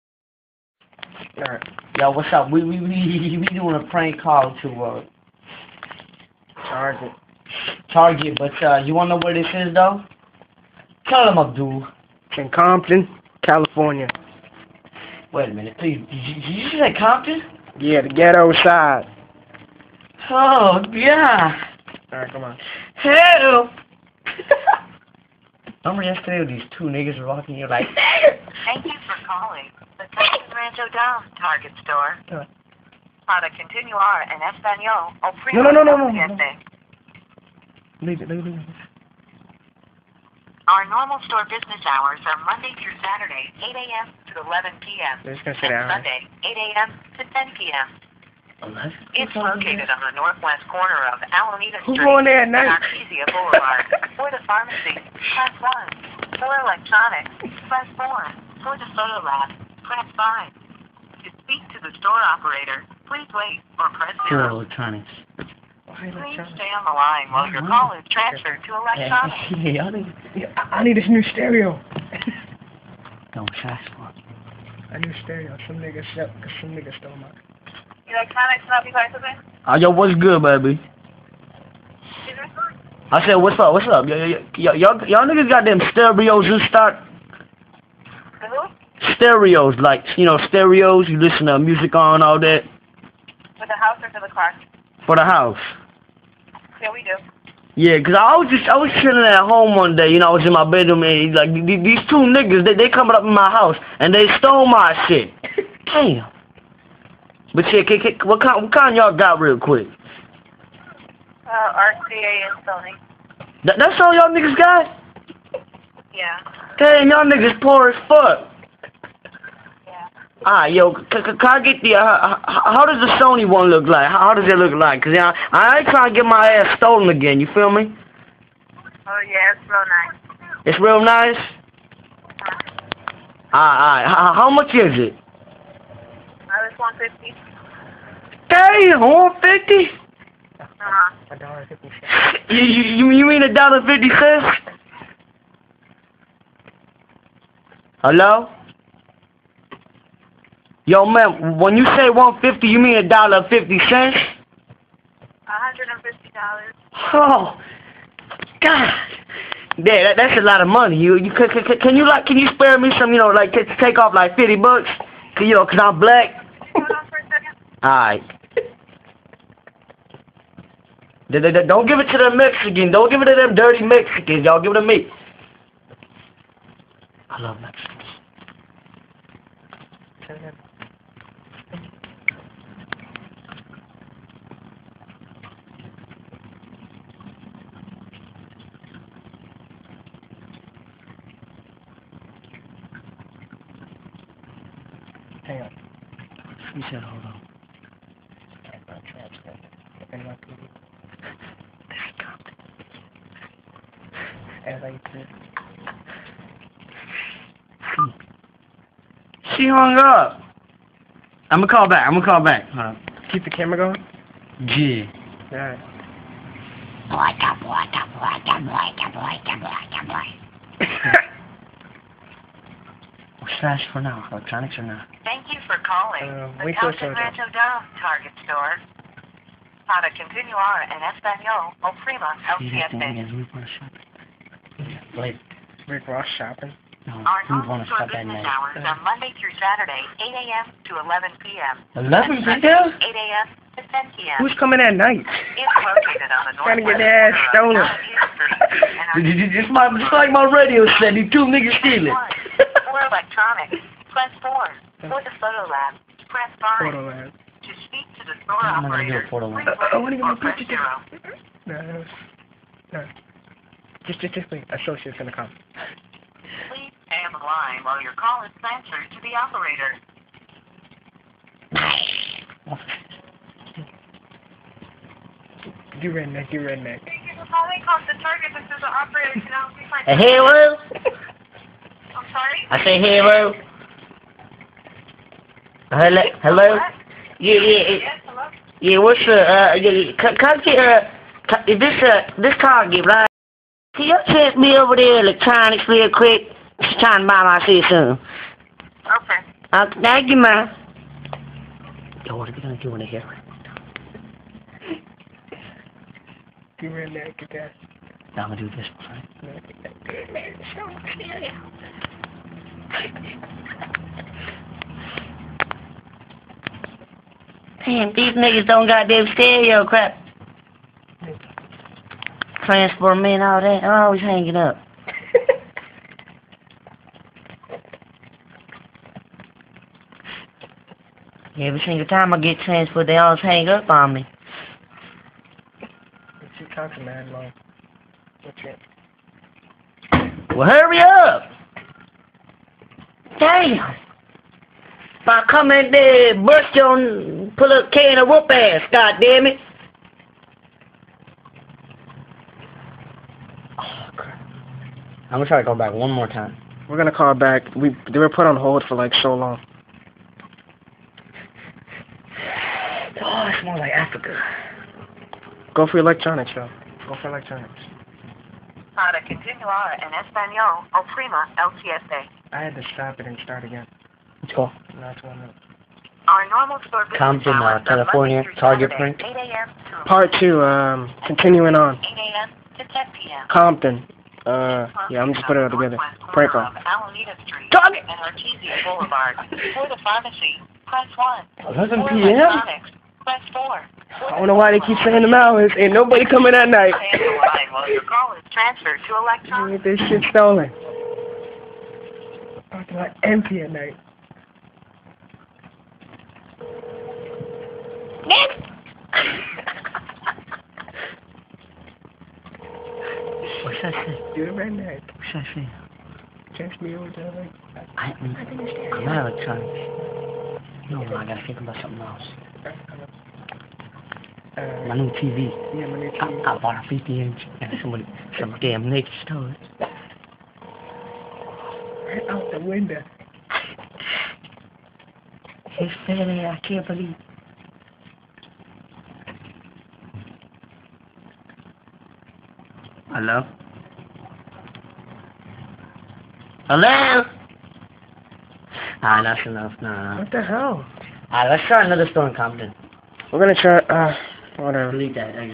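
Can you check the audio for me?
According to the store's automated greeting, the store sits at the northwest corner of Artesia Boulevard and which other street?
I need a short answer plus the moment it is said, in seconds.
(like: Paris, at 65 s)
Alameda Street, at 51 s.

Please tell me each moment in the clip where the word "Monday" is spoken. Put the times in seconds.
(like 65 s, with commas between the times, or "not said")
42 s, 239 s.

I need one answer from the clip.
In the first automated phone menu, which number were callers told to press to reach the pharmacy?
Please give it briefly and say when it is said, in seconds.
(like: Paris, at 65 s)
1, at 55 s.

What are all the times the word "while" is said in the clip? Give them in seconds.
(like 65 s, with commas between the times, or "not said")
67 s, 267 s.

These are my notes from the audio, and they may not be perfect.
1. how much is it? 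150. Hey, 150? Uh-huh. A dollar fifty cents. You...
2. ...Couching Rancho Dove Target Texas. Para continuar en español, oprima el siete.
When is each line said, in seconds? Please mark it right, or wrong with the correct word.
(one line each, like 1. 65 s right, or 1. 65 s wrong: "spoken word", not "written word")
1. 134 s right
2. 226 s wrong: "Store", not "Texas".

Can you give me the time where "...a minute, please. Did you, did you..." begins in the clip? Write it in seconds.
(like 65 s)
15 s.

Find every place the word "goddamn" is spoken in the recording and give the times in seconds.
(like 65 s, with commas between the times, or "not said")
319 s.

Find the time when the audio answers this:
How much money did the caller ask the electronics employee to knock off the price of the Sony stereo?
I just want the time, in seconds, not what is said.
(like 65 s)
164 s.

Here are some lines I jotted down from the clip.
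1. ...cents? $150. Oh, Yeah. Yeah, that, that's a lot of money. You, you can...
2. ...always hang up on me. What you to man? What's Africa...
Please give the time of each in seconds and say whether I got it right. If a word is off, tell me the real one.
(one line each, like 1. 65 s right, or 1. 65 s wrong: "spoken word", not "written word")
1. 153 s wrong: "God", not "Yeah"
2. 333 s wrong: "Well", not "Africa".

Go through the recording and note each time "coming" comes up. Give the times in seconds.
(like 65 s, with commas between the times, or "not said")
102 s, 244 s, 345 s, 396 s.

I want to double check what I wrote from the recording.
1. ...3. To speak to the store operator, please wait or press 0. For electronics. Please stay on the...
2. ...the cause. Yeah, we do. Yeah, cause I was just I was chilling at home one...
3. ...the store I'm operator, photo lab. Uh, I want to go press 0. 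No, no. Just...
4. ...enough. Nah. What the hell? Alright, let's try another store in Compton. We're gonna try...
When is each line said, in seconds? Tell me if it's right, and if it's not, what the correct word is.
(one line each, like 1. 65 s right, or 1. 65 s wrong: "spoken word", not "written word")
1. 60 s wrong: "5", not "3"
2. 95 s wrong: "house", not "cause"
3. 258 s right
4. 449 s right.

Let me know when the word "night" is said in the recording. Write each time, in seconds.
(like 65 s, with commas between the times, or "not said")
238 s, 244 s, 396 s, 403 s.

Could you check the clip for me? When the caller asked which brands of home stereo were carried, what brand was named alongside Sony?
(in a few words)
RCA.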